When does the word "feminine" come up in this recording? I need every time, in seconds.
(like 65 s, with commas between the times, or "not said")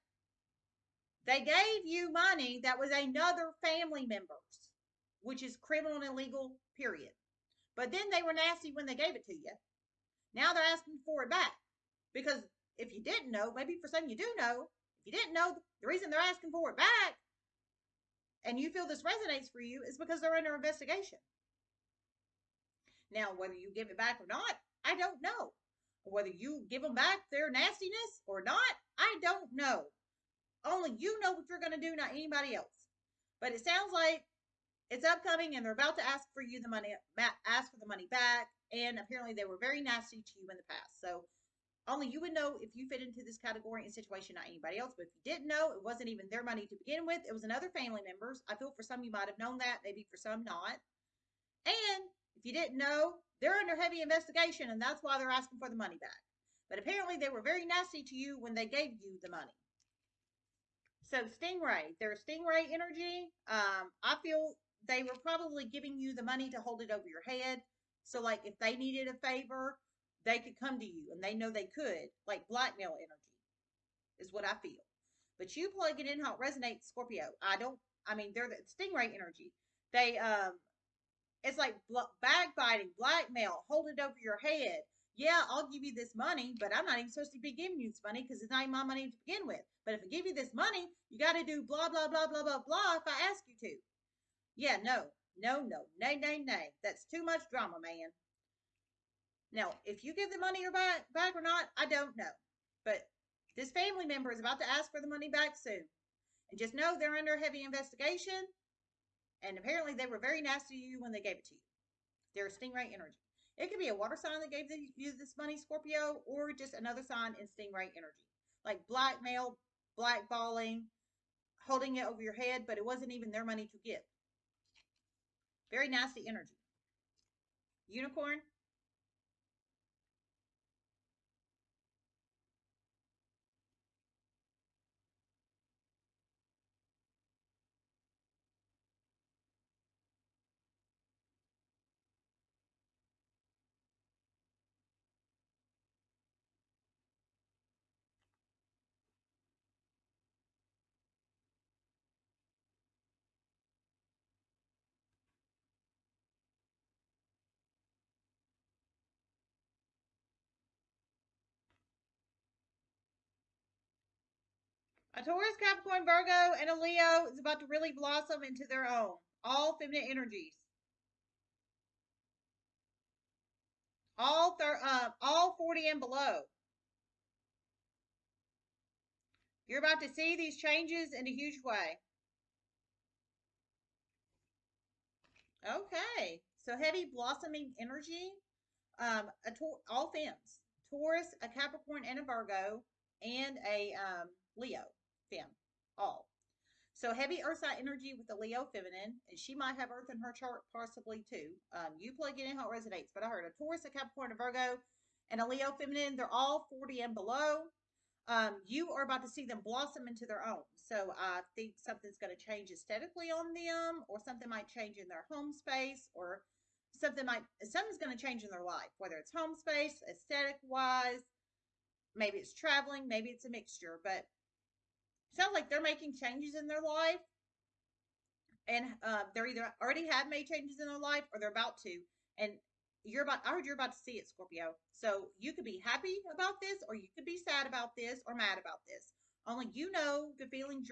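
169 s, 198 s, 205 s.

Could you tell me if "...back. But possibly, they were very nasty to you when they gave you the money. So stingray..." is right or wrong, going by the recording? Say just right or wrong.
wrong.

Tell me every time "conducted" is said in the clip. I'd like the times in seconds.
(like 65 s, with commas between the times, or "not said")
not said.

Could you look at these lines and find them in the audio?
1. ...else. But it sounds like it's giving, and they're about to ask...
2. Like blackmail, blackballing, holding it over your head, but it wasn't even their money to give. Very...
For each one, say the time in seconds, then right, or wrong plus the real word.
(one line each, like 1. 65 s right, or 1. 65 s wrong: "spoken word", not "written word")
1. 32 s wrong: "upcoming", not "giving"
2. 118 s right.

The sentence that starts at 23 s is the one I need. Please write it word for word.
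Now, whether you give it back or not, I don't know.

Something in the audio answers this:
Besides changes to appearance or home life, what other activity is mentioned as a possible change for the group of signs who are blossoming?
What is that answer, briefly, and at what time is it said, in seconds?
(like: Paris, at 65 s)
Traveling, at 222 s.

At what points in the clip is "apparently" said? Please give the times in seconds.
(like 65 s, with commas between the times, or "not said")
38 s, 56 s, 109 s.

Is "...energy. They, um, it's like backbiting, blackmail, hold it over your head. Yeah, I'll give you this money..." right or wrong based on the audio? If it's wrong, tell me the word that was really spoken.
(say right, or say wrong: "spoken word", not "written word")
right.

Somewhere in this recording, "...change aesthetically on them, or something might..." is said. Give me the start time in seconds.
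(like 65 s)
212 s.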